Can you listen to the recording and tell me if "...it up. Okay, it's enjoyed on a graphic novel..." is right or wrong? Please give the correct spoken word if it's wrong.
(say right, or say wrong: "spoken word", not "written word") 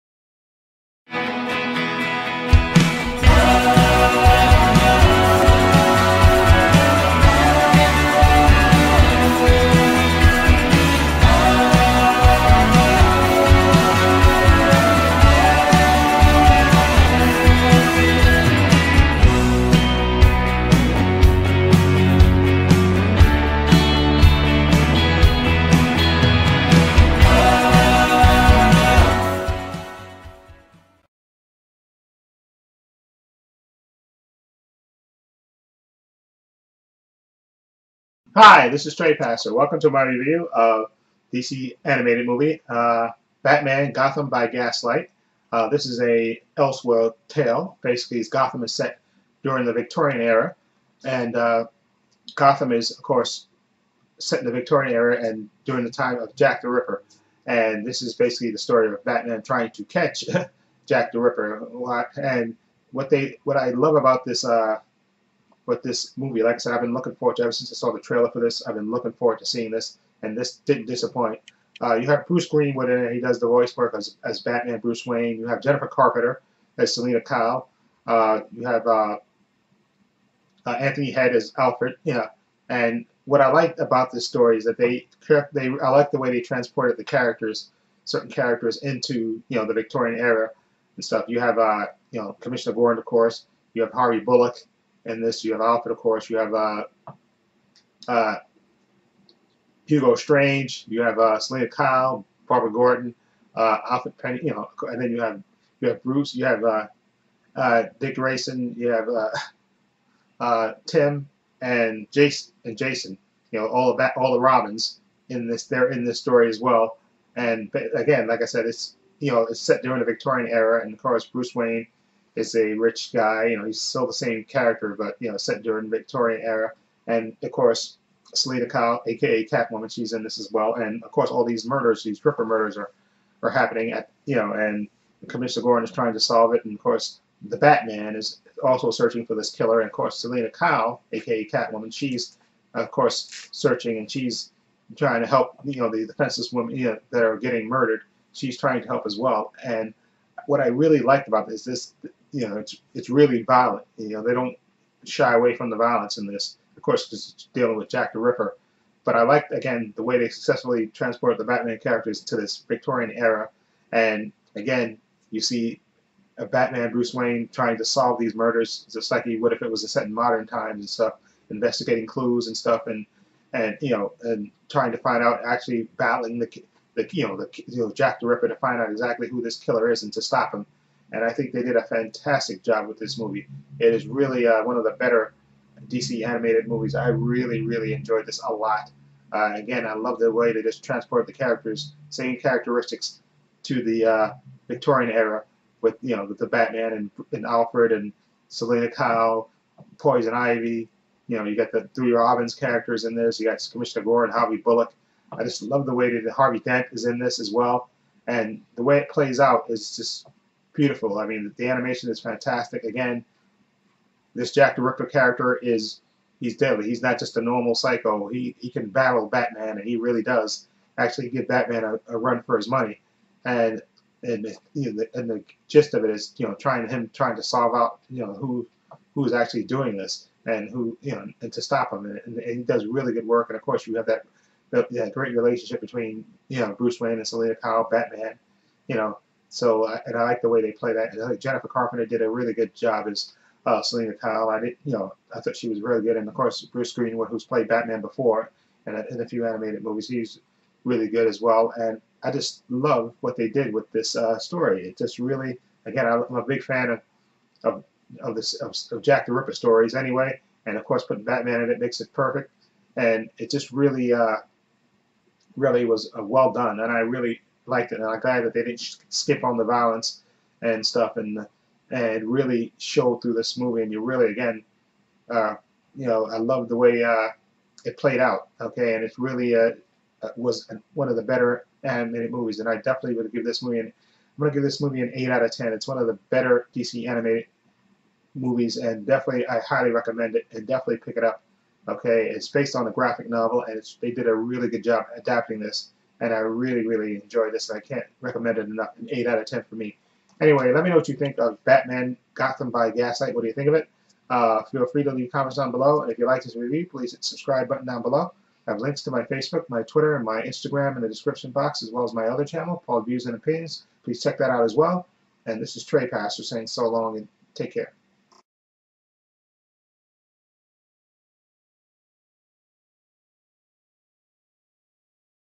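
wrong: "based", not "enjoyed".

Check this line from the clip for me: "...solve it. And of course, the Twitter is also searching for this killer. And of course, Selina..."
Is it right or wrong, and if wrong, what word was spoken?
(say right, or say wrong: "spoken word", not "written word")
wrong: "Batman", not "Twitter".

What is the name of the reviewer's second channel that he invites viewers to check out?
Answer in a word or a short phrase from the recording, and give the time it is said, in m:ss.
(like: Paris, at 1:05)
Paul Views and Opinions, at 5:12.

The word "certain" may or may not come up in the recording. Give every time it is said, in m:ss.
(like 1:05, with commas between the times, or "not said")
1:28.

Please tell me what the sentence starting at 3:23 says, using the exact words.
You got Commissioner Gordon and Harvey Bullock.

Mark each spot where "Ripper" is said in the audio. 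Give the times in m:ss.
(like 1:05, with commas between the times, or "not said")
0:56, 1:01, 2:12, 2:38, 2:58, 3:34, 4:19.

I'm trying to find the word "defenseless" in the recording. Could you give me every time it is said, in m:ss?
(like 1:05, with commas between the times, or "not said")
2:26.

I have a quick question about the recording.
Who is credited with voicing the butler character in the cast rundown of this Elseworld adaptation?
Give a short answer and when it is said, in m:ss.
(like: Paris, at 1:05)
Anthony Head, at 1:20.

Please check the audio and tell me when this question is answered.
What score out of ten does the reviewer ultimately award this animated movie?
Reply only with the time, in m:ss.
4:45.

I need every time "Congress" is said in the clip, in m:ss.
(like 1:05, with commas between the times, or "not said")
not said.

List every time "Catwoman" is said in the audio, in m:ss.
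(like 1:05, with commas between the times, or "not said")
2:09, 2:21.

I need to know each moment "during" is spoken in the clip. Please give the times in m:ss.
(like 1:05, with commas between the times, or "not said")
0:49, 0:55, 1:59, 2:05.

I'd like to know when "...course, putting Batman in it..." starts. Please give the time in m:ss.
4:20.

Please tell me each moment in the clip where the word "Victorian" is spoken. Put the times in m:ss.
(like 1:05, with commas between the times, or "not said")
0:49, 0:54, 1:29, 2:00, 2:05, 2:42, 3:14.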